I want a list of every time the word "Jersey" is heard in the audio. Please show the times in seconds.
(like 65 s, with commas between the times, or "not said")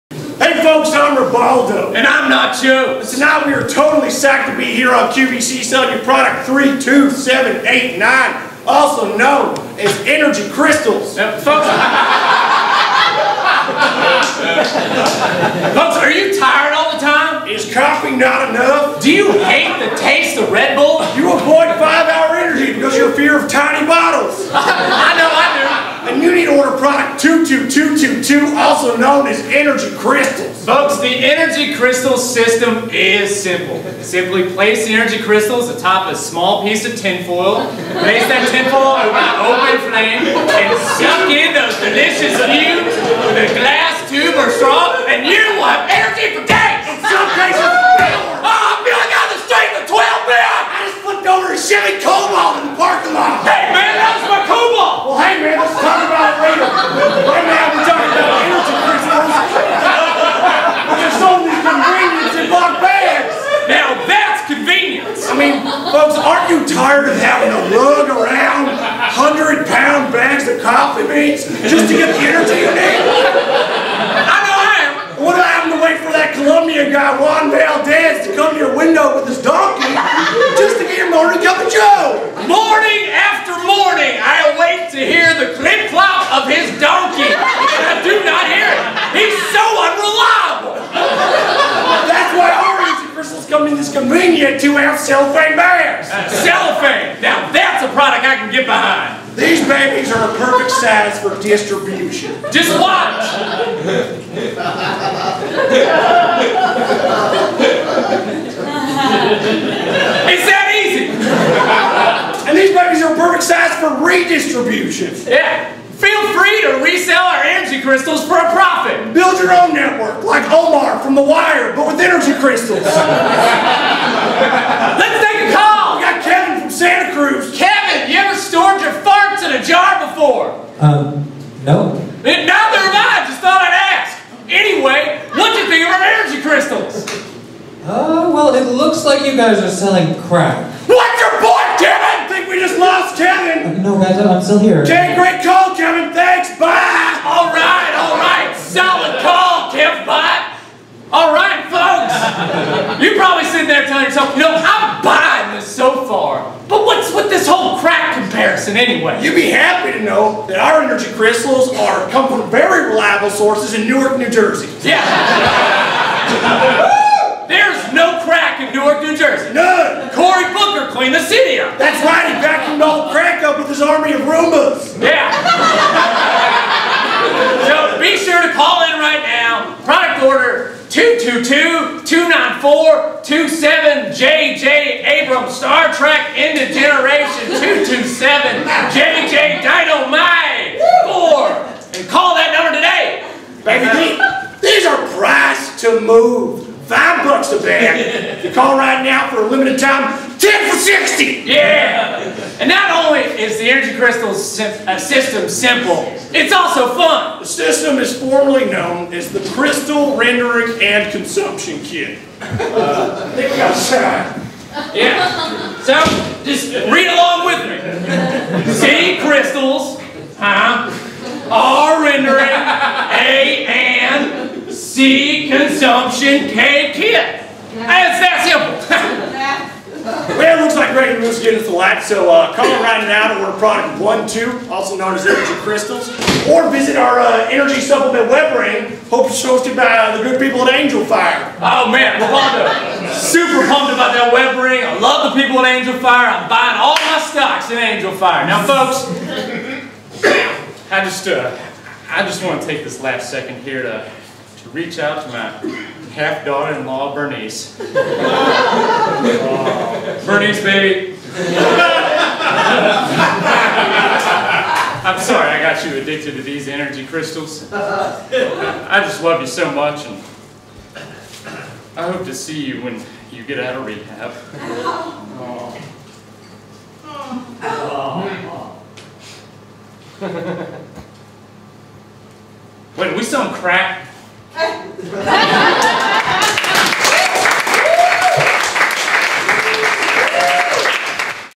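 164 s, 169 s.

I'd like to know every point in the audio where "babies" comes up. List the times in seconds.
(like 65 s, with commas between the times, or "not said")
99 s, 112 s.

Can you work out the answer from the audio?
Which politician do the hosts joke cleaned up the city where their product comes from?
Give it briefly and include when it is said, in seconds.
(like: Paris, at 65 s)
Cory Booker, at 170 s.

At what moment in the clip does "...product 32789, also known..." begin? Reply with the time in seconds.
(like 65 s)
6 s.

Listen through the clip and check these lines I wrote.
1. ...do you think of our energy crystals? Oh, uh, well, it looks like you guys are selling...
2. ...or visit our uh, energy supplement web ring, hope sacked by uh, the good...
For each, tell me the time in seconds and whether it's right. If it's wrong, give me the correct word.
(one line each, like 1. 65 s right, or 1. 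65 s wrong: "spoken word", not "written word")
1. 135 s right
2. 236 s wrong: "hosted", not "sacked".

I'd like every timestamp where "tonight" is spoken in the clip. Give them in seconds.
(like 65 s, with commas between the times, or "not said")
3 s.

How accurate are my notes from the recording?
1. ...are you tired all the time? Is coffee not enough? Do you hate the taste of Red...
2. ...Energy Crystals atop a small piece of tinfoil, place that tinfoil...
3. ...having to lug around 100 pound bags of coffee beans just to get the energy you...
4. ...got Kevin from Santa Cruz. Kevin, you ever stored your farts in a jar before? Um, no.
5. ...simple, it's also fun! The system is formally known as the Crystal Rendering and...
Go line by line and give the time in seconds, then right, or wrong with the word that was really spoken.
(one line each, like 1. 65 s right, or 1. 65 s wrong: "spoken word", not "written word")
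1. 15 s right
2. 34 s right
3. 67 s right
4. 126 s right
5. 205 s right.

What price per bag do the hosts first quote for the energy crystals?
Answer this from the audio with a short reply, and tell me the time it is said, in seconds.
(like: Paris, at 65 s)
$5, at 196 s.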